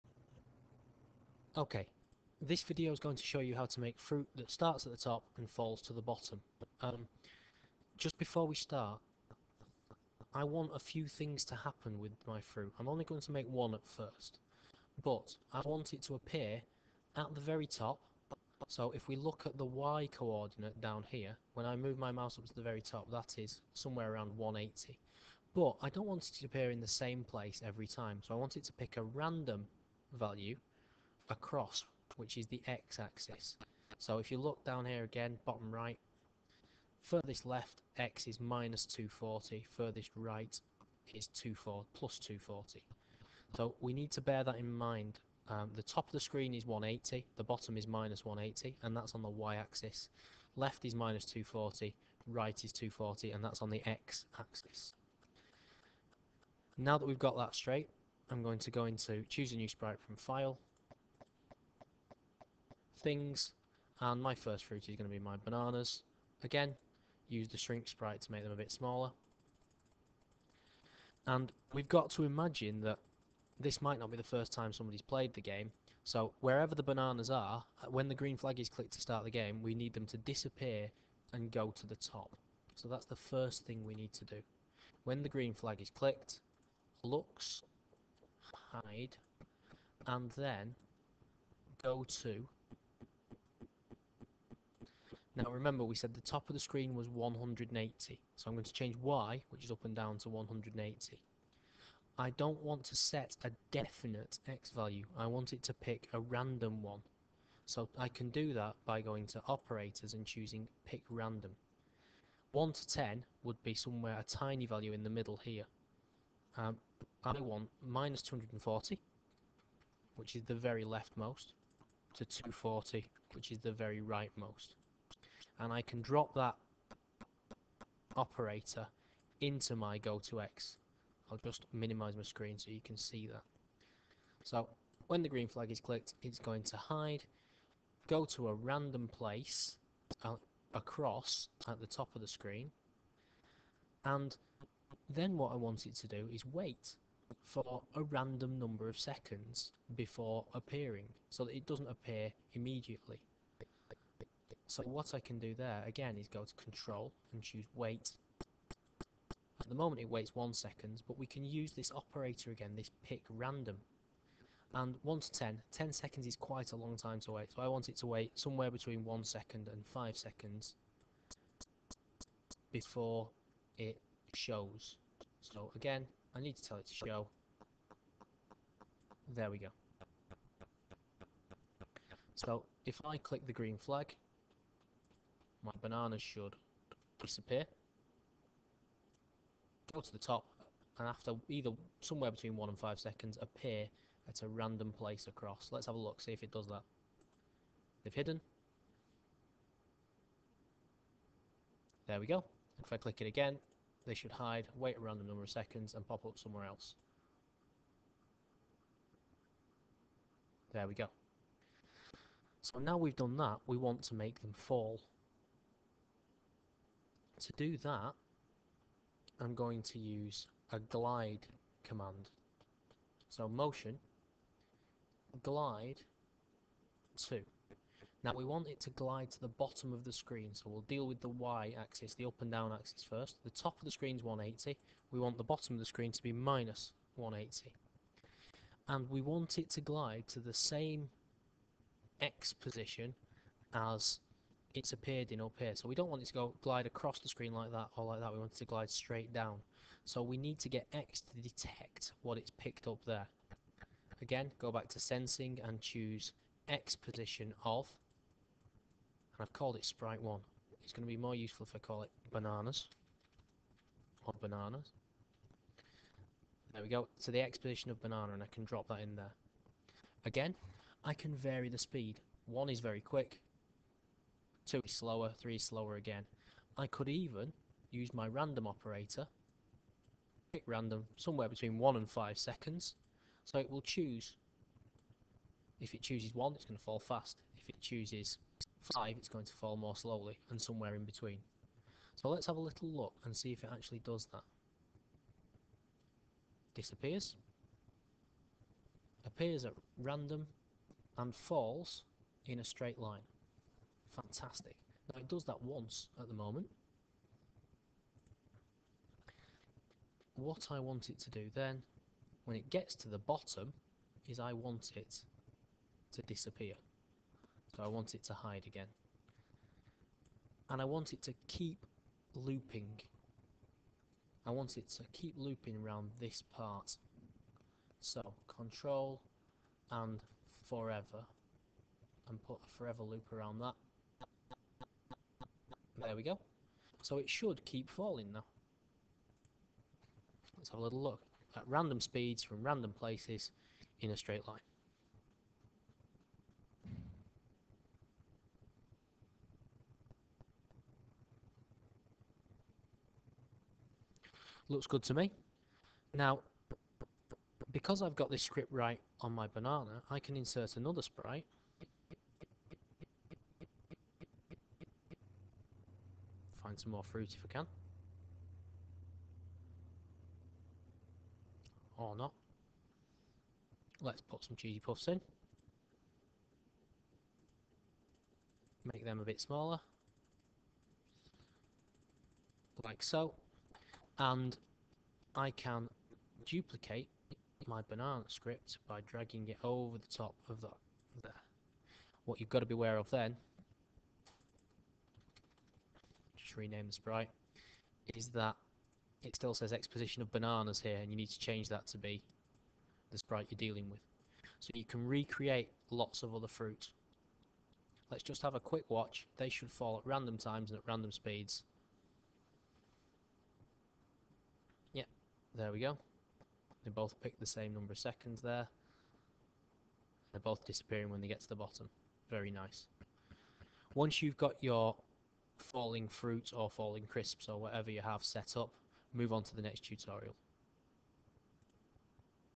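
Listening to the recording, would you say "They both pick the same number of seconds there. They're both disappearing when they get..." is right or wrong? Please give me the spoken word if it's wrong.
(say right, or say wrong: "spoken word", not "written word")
right.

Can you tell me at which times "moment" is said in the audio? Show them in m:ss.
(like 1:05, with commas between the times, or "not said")
2:39, 5:06.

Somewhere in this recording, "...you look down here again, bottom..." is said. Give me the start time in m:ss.
0:34.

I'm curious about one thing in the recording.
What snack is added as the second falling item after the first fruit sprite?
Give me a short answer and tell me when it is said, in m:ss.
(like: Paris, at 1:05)
Cheesy puffs, at 6:14.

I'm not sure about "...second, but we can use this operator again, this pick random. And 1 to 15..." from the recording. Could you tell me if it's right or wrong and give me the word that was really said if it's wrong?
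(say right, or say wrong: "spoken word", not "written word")
wrong: "10", not "15".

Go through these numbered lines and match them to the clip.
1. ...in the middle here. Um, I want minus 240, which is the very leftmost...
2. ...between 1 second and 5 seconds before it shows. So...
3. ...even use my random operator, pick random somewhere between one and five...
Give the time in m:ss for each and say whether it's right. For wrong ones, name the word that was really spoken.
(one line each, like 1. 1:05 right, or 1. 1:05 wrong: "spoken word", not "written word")
1. 1:54 right
2. 2:48 right
3. 4:37 right.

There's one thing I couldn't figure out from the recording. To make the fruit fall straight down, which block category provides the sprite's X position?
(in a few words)
Sensing.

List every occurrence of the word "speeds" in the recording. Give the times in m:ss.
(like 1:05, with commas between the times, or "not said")
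4:31, 5:41, 6:51.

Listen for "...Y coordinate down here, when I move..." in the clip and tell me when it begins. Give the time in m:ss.
0:19.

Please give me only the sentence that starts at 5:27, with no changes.
So control and forever and put a forever loop around that there we go.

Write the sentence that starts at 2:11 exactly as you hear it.
I'll just minimize my screen so you can see that.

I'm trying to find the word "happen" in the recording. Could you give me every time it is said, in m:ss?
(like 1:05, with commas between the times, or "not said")
0:11.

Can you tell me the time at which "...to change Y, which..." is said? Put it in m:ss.
1:38.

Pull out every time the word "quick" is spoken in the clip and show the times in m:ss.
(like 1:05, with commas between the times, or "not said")
4:33, 6:48.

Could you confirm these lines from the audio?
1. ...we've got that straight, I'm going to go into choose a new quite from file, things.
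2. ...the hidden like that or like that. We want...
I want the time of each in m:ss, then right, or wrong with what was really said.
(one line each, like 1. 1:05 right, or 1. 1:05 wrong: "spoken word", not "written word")
1. 0:57 wrong: "sprite", not "quite"
2. 4:07 wrong: "screen", not "hidden".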